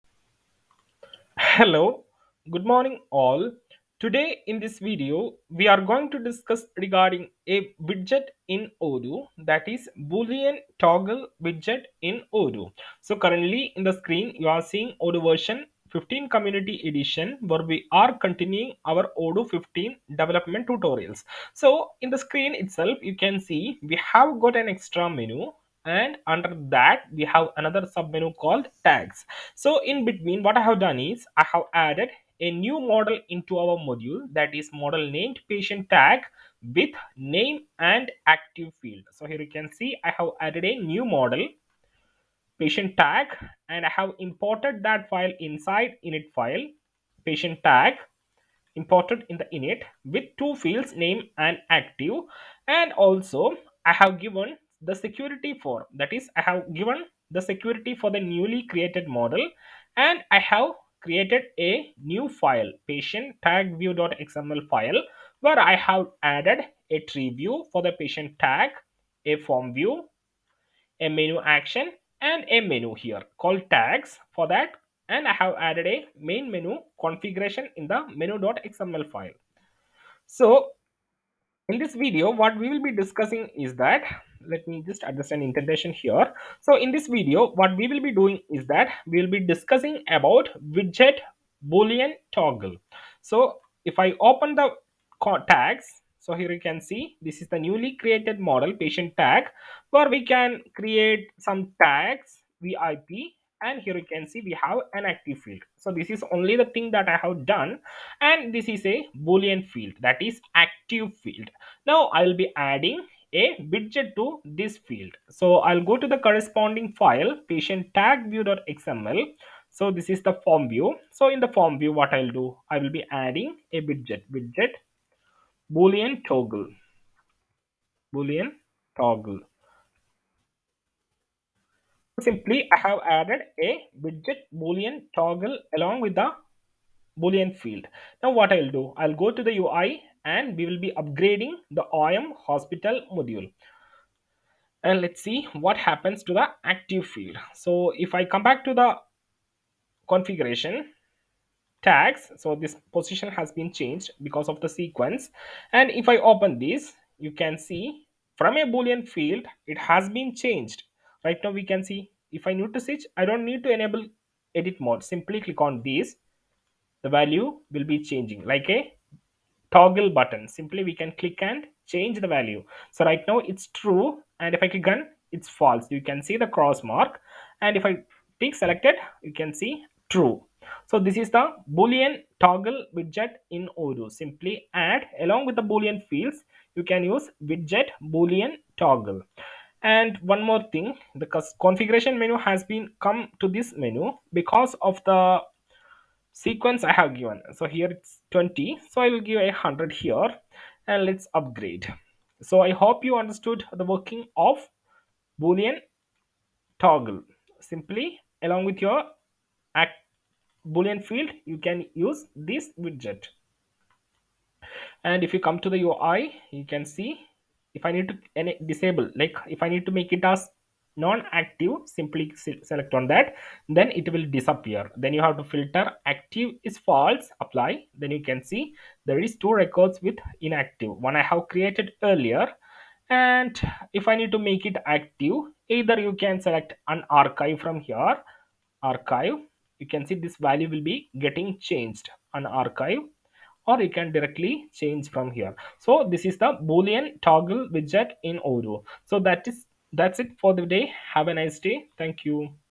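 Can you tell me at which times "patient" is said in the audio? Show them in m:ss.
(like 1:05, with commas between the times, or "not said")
0:35, 0:42, 0:47, 1:02, 1:07, 1:38, 1:57.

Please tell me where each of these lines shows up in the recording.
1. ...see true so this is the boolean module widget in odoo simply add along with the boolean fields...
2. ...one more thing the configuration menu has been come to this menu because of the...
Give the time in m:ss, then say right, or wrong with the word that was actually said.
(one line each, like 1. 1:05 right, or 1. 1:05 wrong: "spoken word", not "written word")
1. 2:59 wrong: "toggle", not "module"
2. 3:10 right.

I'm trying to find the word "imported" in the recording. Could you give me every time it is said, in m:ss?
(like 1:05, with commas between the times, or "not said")
0:44, 0:48.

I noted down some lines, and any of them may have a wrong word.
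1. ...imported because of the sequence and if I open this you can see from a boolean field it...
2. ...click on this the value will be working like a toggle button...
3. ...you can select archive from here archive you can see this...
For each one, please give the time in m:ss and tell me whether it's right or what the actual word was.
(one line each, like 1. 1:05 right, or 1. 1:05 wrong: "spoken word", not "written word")
1. 2:33 wrong: "changed", not "imported"
2. 2:45 wrong: "changing", not "working"
3. 3:55 wrong: "unarchive", not "archive".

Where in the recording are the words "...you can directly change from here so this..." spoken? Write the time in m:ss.
4:03.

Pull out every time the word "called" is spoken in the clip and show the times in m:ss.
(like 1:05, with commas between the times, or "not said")
0:28, 1:13.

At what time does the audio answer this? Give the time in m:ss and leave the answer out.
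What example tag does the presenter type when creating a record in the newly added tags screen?
1:42.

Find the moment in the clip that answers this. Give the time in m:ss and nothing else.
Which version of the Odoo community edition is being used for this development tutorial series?
0:15.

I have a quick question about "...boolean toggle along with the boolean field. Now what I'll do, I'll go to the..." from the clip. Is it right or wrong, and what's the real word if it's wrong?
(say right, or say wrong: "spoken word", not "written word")
right.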